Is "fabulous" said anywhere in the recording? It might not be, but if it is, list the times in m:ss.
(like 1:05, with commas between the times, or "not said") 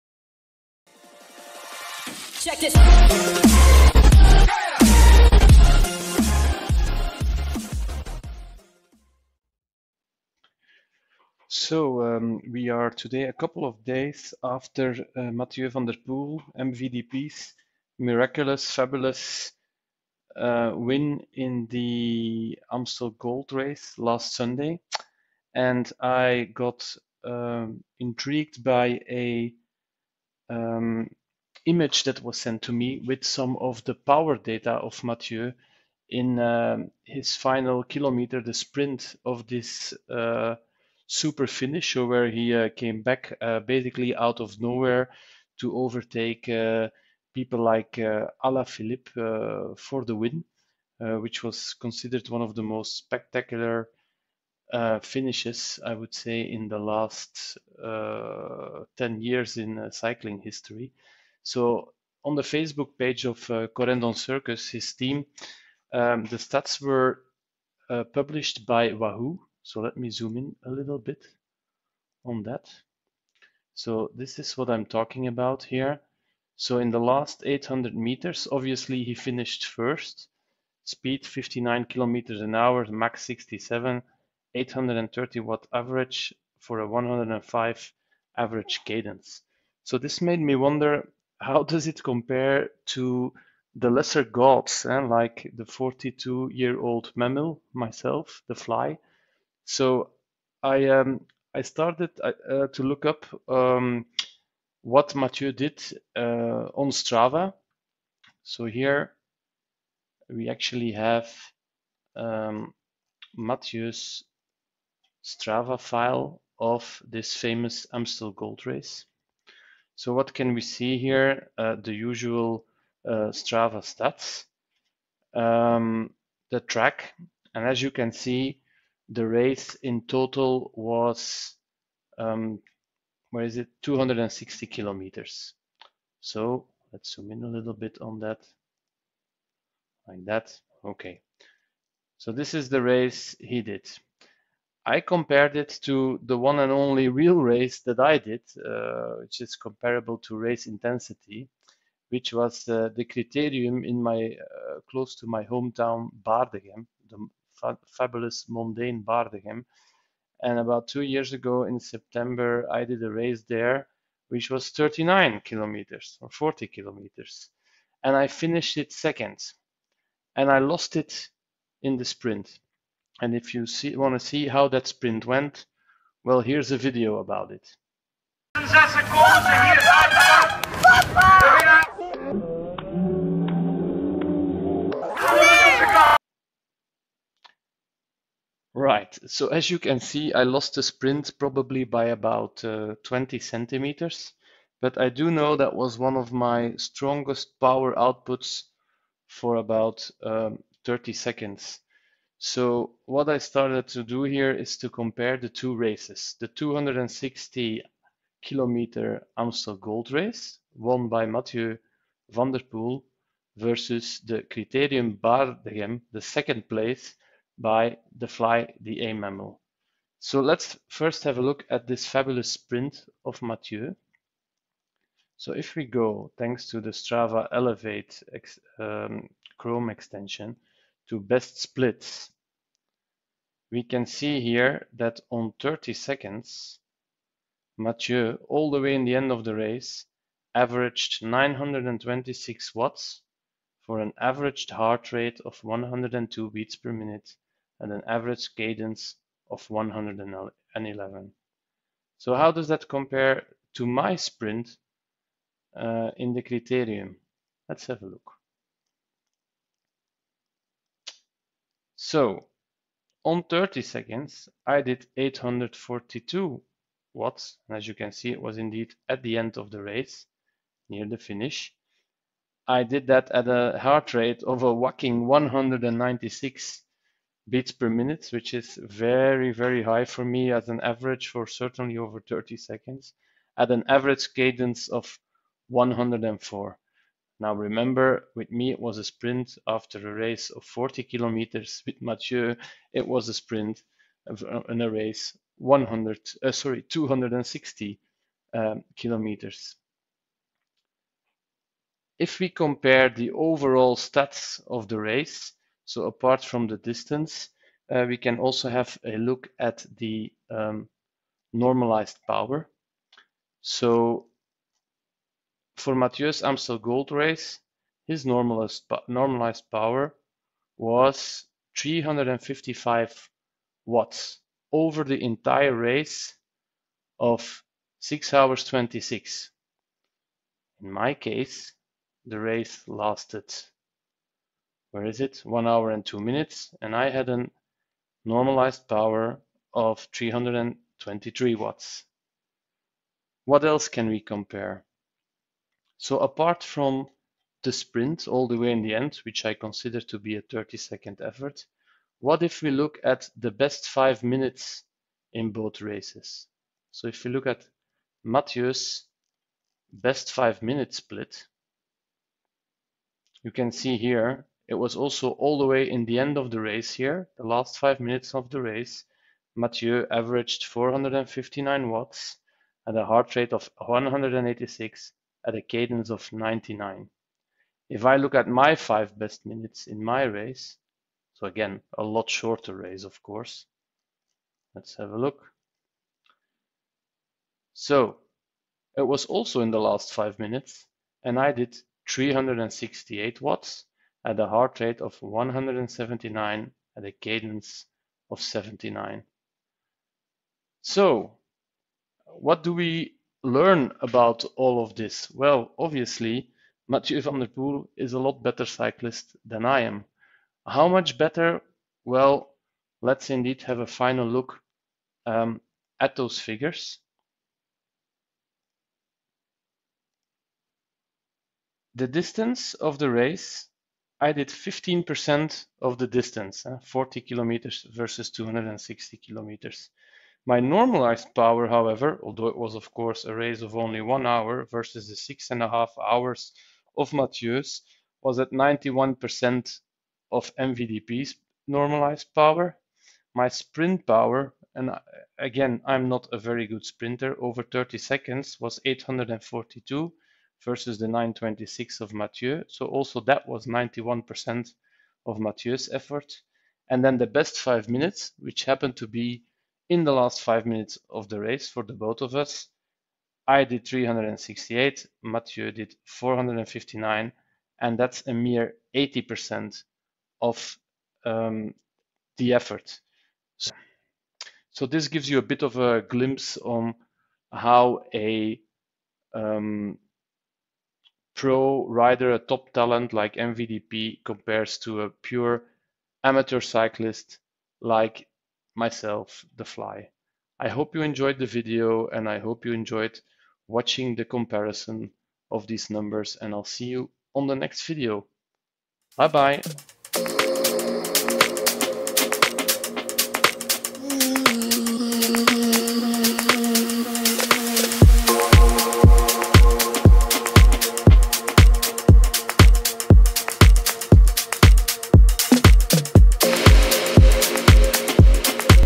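0:18, 2:37, 3:42.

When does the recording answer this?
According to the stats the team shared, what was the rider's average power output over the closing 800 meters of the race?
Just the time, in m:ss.
1:24.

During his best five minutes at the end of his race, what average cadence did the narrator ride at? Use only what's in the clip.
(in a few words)
79.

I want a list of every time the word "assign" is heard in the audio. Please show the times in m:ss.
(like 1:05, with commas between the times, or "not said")
not said.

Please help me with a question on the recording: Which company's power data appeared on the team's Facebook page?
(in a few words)
Wahoo.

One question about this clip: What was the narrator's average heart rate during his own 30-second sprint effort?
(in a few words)
196 beats per minute.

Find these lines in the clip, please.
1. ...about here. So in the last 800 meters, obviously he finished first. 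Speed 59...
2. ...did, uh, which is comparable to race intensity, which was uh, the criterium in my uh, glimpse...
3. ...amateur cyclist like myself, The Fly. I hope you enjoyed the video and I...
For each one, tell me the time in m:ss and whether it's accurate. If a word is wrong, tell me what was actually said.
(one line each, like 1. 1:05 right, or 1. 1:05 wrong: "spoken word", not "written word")
1. 1:15 right
2. 2:28 wrong: "close", not "glimpse"
3. 8:06 right.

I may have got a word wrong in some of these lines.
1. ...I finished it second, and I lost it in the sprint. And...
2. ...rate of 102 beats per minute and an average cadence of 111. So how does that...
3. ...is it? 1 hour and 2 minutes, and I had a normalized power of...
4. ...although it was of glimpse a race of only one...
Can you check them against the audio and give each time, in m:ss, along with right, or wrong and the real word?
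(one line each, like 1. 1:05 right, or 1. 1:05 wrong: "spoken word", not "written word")
1. 2:48 right
2. 4:05 right
3. 5:35 right
4. 7:12 wrong: "course", not "glimpse".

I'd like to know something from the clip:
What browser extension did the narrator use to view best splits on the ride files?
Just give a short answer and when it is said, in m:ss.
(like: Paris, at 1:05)
Strava Elevate, at 3:46.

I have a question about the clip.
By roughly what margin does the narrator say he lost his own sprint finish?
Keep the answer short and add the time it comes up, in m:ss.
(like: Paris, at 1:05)
20 centimeters, at 3:13.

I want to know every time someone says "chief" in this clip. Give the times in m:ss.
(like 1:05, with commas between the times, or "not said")
not said.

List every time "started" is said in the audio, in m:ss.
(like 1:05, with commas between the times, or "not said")
1:41, 3:23.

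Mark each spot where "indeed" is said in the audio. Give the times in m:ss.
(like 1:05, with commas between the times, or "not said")
4:28, 6:53.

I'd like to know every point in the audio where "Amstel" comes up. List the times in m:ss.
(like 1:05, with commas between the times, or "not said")
0:22, 1:57, 3:29, 5:16.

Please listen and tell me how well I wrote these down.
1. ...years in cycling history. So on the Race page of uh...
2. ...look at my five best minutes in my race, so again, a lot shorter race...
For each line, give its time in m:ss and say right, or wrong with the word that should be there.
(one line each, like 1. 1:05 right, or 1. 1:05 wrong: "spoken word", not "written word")
1. 0:59 wrong: "Facebook", not "Race"
2. 6:18 right.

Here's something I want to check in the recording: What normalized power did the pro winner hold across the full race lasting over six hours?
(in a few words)
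355 watts.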